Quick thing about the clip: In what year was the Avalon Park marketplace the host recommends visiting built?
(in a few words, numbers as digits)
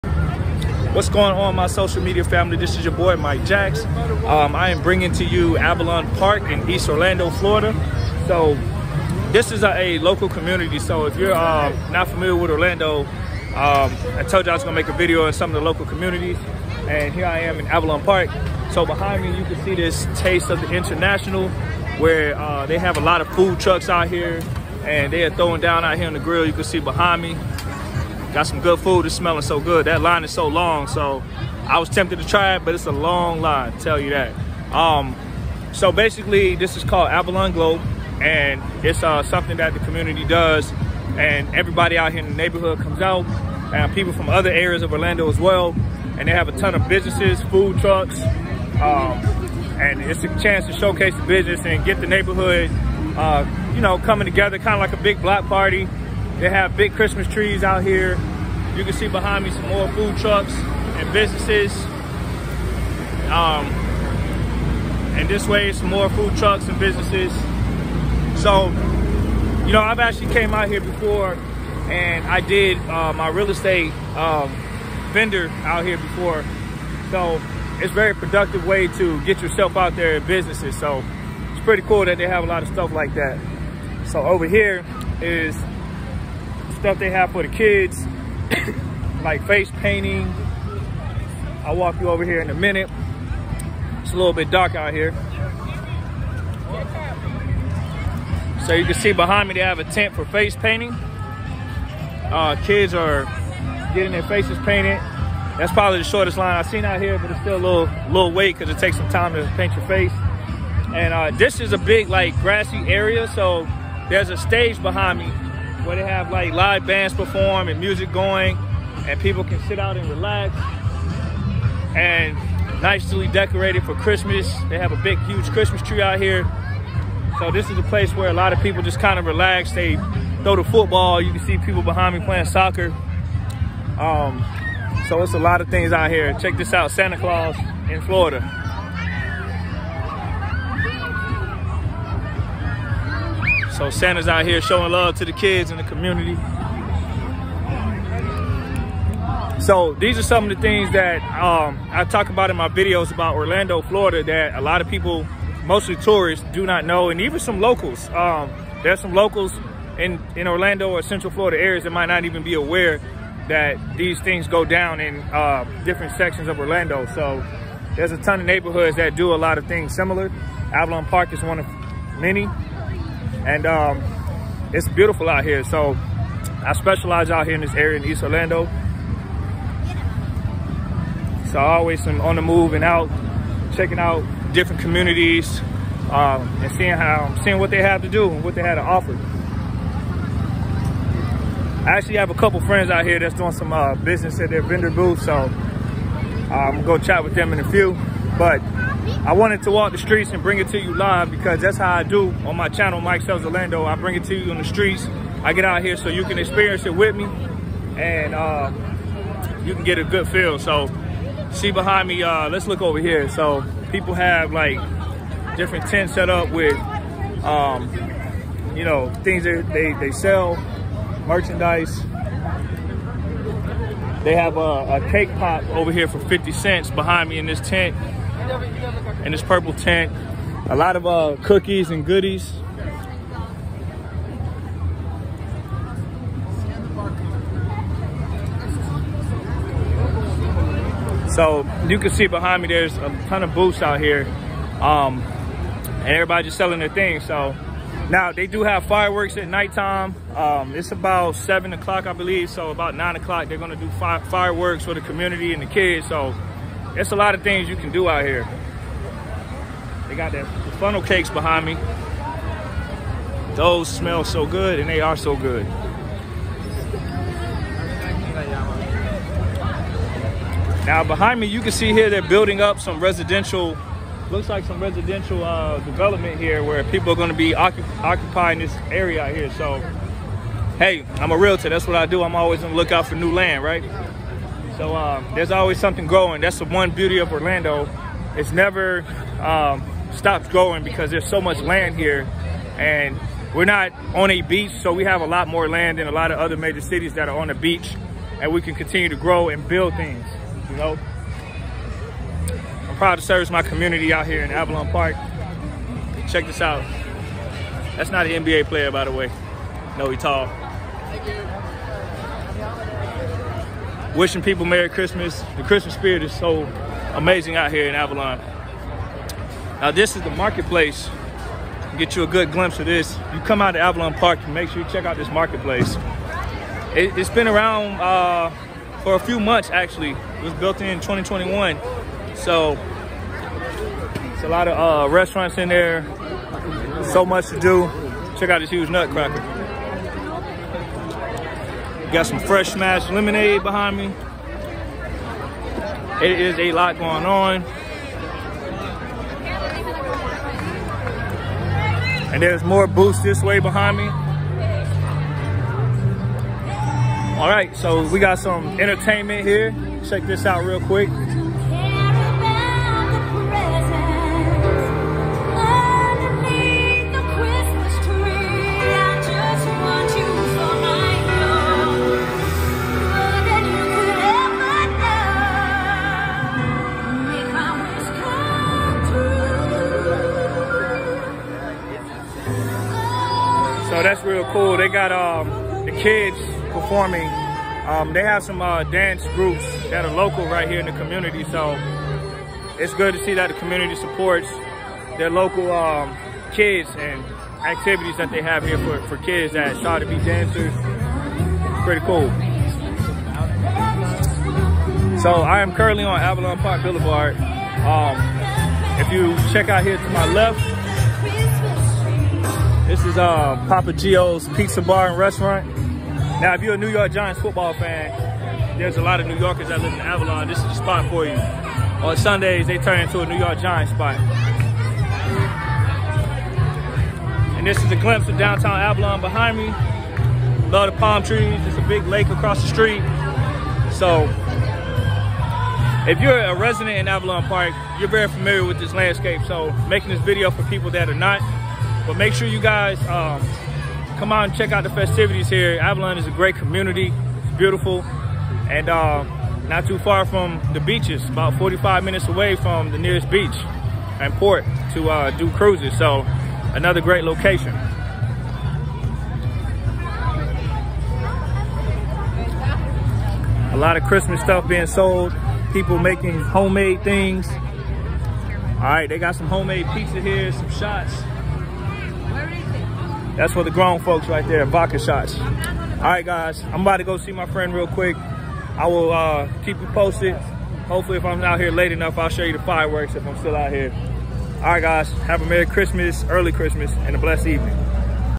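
2021.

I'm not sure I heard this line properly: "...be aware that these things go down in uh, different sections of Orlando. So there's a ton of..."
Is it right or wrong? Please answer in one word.
right.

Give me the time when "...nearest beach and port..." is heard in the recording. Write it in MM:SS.
07:32.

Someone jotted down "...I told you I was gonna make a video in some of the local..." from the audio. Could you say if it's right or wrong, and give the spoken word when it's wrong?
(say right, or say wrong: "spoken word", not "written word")
right.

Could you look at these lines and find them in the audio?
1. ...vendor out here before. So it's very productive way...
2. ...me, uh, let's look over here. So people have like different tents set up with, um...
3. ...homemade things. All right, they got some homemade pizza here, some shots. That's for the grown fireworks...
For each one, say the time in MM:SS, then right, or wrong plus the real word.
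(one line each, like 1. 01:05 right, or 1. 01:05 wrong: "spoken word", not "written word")
1. 01:15 right
2. 03:32 right
3. 07:46 wrong: "folks", not "fireworks".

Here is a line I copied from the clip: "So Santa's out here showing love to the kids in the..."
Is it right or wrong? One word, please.
right.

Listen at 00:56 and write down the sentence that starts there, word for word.
They have big Christmas trees out here.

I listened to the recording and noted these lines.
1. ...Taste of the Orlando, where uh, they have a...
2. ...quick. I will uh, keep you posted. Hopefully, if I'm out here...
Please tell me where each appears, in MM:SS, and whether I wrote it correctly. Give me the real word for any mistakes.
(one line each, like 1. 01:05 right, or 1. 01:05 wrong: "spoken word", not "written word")
1. 00:20 wrong: "International", not "Orlando"
2. 07:57 right.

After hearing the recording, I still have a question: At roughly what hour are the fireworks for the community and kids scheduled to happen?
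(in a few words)
9 o'clock.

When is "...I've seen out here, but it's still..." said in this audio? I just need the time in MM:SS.
01:46.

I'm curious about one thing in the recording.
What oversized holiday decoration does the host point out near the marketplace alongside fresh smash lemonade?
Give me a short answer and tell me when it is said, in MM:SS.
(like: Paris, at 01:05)
Nutcracker, at 05:38.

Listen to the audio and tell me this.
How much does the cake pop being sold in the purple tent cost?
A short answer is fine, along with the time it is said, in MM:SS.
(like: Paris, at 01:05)
50 cents, at 03:46.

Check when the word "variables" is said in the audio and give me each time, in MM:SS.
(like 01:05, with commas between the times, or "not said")
not said.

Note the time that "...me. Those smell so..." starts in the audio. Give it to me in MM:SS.
04:21.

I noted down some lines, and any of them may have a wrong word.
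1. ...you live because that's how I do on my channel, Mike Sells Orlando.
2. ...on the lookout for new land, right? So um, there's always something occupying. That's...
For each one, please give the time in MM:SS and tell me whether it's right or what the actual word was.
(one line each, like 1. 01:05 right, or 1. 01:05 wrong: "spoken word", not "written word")
1. 03:20 right
2. 04:42 wrong: "growing", not "occupying".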